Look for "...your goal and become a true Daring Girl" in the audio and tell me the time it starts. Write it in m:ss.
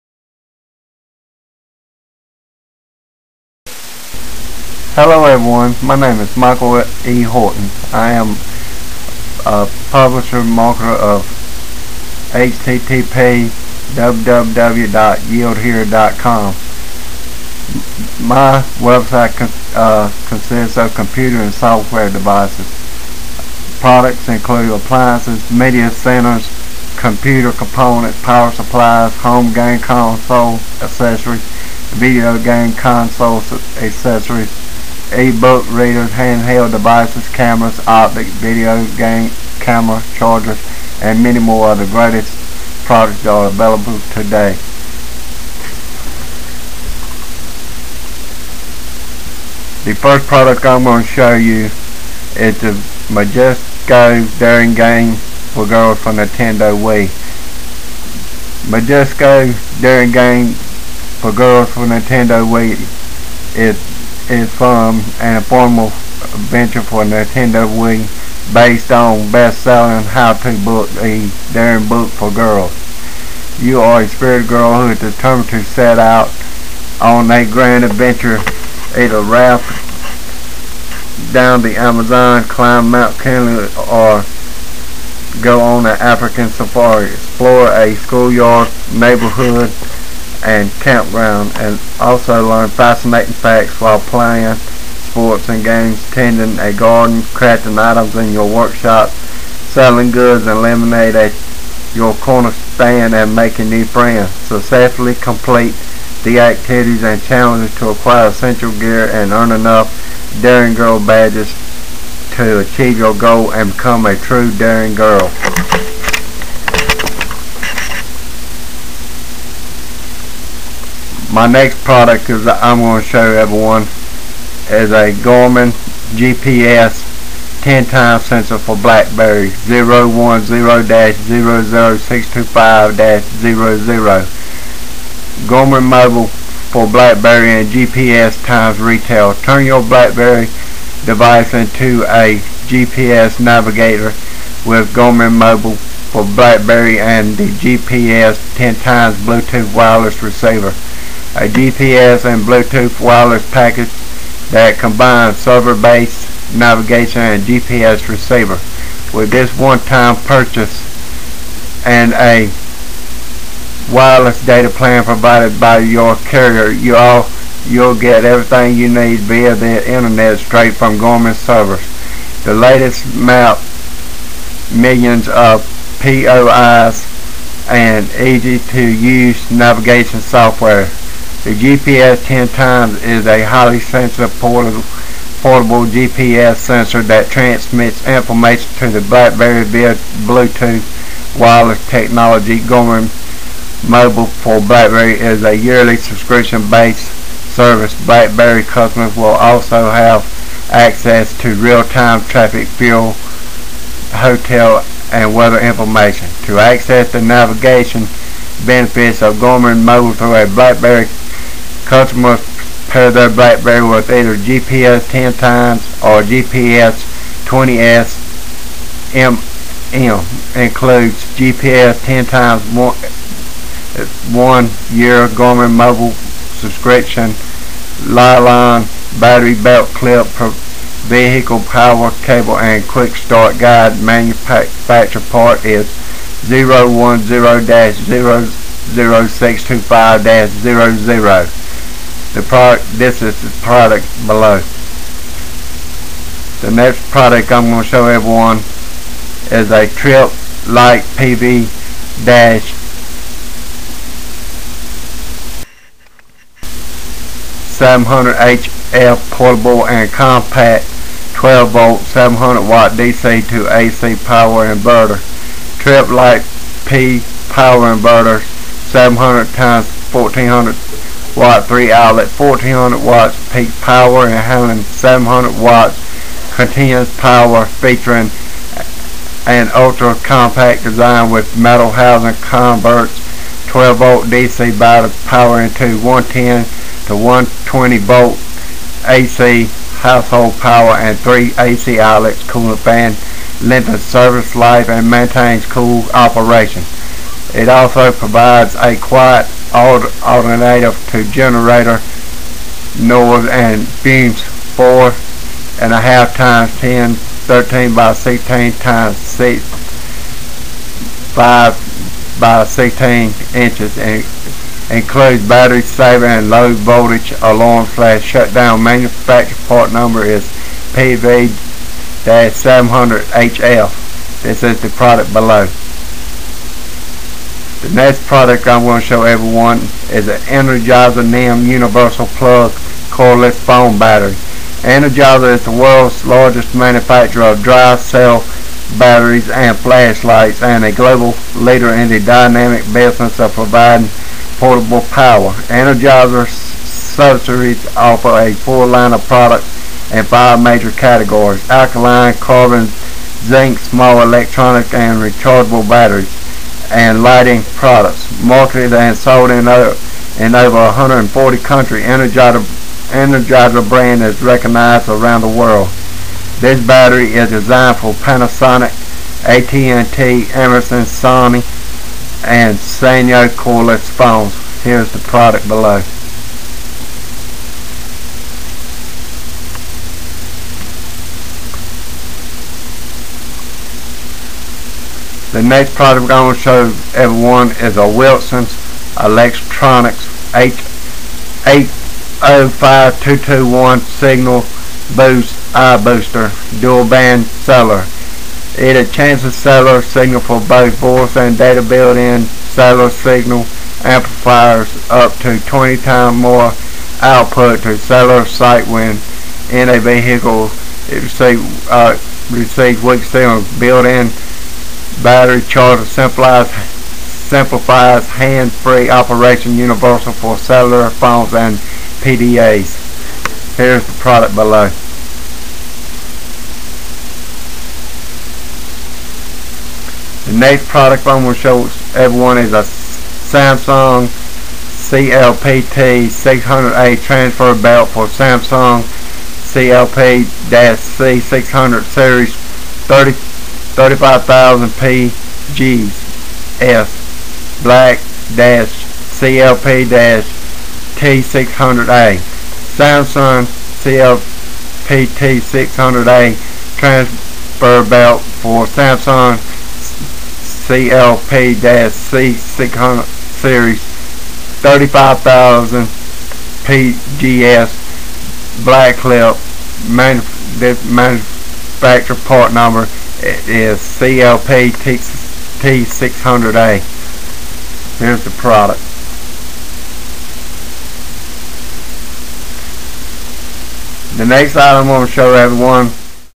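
1:52.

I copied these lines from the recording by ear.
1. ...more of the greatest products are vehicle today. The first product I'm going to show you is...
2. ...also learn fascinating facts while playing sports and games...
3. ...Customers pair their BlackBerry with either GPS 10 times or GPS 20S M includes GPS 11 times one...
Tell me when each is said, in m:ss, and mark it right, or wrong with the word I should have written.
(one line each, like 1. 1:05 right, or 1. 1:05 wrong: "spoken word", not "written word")
1. 0:41 wrong: "available", not "vehicle"
2. 1:31 right
3. 3:31 wrong: "10", not "11".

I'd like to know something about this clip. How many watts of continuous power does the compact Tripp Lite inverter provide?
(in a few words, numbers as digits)
700 watts.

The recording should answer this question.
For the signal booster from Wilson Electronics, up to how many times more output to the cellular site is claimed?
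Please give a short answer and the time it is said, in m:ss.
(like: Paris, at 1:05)
20 times, at 6:45.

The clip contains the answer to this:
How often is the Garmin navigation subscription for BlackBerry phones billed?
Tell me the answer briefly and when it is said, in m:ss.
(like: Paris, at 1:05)
Yearly, at 3:15.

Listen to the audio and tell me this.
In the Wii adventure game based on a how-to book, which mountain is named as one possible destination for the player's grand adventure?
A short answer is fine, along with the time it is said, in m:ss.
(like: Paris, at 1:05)
Mount Kenya, at 1:22.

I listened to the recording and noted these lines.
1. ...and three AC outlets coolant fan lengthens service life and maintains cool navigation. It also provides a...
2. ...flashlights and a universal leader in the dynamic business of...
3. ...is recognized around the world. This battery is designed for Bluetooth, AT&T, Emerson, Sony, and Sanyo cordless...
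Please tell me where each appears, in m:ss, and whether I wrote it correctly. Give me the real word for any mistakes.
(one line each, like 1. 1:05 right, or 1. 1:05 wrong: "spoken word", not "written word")
1. 4:50 wrong: "operation", not "navigation"
2. 5:39 wrong: "global", not "universal"
3. 6:04 wrong: "Panasonic", not "Bluetooth".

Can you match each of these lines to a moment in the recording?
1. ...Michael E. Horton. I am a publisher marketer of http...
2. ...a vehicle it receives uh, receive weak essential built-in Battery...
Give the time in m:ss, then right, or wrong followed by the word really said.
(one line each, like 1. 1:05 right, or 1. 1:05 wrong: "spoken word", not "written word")
1. 0:06 right
2. 6:49 wrong: "signal", not "essential".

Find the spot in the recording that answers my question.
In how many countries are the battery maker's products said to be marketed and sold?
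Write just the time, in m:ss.
6:00.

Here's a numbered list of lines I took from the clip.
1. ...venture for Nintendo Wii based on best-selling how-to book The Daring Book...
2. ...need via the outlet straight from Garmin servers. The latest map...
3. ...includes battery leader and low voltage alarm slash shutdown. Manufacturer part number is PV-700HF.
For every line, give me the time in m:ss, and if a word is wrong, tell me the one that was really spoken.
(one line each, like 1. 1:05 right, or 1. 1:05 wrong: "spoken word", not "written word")
1. 1:06 right
2. 2:48 wrong: "internet", not "outlet"
3. 5:14 wrong: "saver", not "leader".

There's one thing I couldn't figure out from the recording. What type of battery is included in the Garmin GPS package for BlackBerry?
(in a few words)
Li-ion.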